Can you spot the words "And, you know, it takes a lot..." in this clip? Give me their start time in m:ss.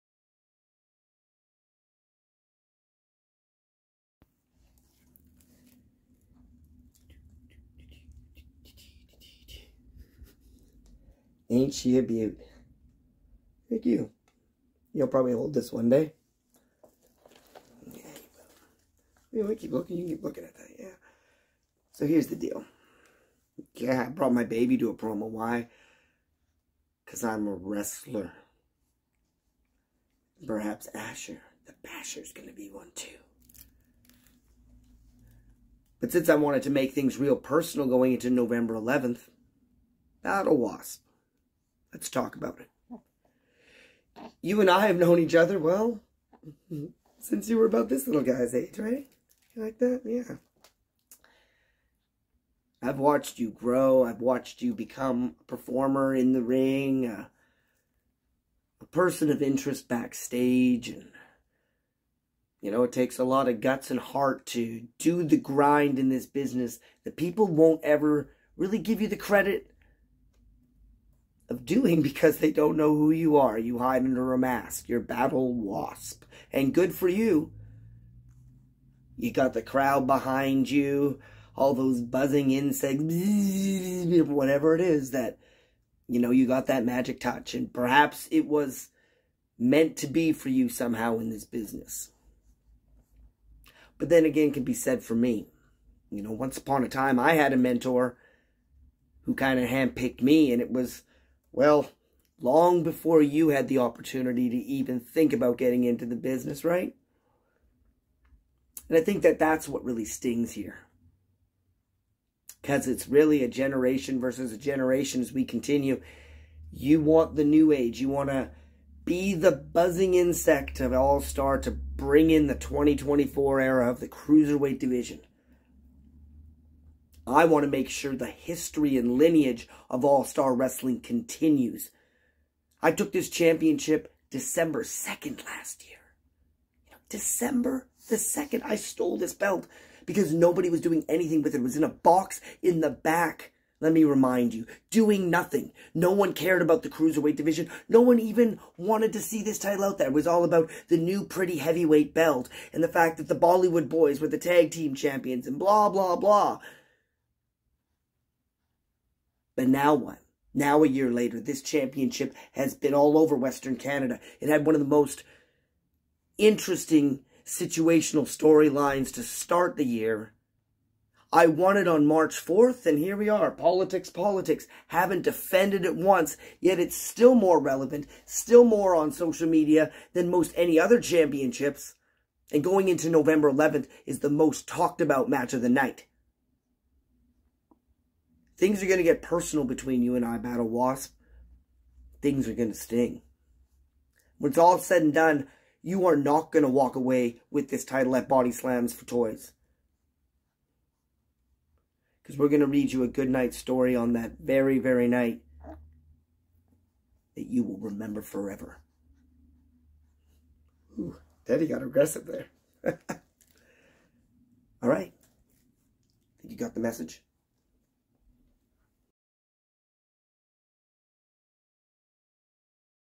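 1:00.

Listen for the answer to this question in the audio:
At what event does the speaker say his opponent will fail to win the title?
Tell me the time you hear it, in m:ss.
3:18.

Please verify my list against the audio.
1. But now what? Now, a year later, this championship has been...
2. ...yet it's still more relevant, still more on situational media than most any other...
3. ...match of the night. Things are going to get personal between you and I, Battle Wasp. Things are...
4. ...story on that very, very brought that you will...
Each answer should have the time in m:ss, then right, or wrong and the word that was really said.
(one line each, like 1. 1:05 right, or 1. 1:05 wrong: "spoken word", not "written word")
1. 2:39 right
2. 2:56 wrong: "social", not "situational"
3. 3:05 right
4. 3:23 wrong: "night", not "brought".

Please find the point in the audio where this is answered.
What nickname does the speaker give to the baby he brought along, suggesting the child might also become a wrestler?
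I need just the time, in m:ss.
0:30.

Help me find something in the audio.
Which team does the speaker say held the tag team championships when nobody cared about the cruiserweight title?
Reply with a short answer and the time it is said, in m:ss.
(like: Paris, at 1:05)
Bollywood Boyz, at 2:33.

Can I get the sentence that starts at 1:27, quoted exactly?
And perhaps it was meant to be for you somehow in this business.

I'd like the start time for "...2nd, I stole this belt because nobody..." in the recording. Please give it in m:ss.
2:18.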